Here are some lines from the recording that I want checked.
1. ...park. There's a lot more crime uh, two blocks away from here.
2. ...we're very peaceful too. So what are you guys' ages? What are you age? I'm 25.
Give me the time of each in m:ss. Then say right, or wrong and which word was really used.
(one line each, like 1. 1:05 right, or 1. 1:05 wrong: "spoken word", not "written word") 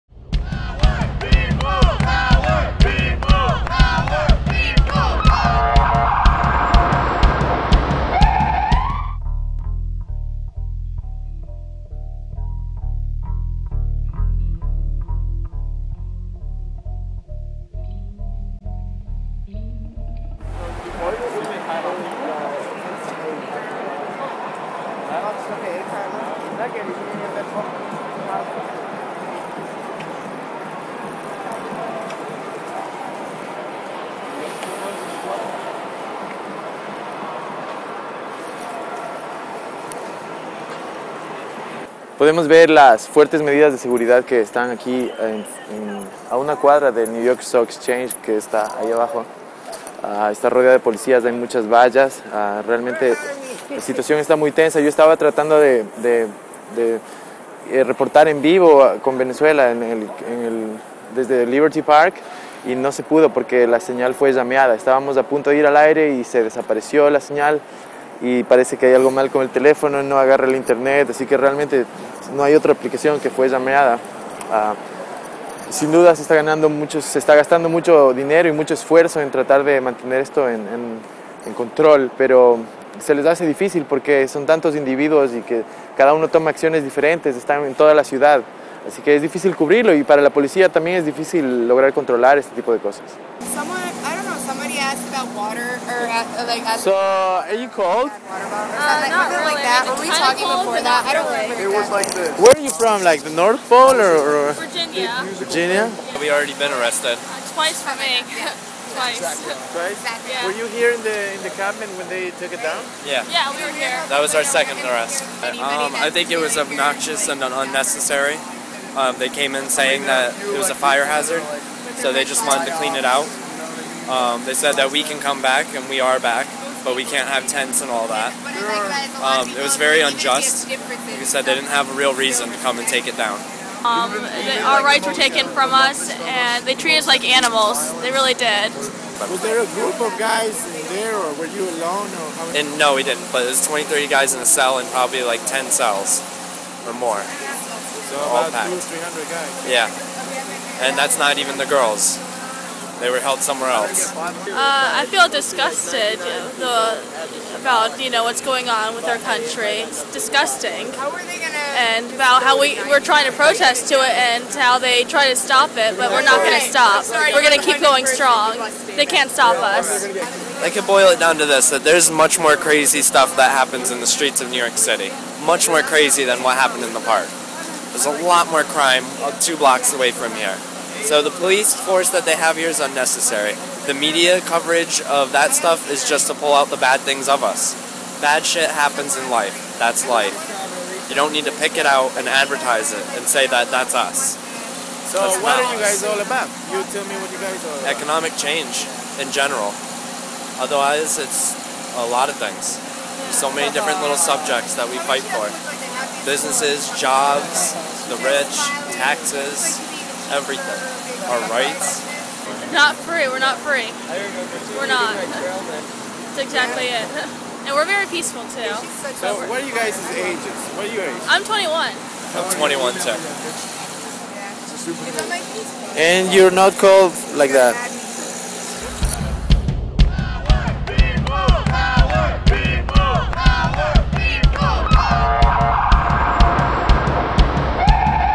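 1. 2:57 right
2. 3:37 wrong: "21", not "25".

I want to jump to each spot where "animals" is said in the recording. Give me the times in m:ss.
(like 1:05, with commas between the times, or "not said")
2:17.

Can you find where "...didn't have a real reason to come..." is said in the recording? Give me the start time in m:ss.
2:11.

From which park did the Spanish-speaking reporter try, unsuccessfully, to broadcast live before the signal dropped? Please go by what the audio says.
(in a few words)
Liberty Park.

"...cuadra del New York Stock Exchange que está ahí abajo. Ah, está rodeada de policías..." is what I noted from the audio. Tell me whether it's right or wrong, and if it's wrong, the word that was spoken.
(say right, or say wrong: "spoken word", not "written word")
right.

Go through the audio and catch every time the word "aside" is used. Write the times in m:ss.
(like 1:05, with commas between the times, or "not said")
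not said.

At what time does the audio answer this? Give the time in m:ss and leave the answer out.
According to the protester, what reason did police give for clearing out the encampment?
2:00.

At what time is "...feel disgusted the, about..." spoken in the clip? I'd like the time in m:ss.
2:35.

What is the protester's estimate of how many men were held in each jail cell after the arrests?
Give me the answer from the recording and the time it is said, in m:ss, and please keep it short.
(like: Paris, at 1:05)
20 to 30, at 2:23.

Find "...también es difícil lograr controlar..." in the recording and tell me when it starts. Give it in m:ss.
1:30.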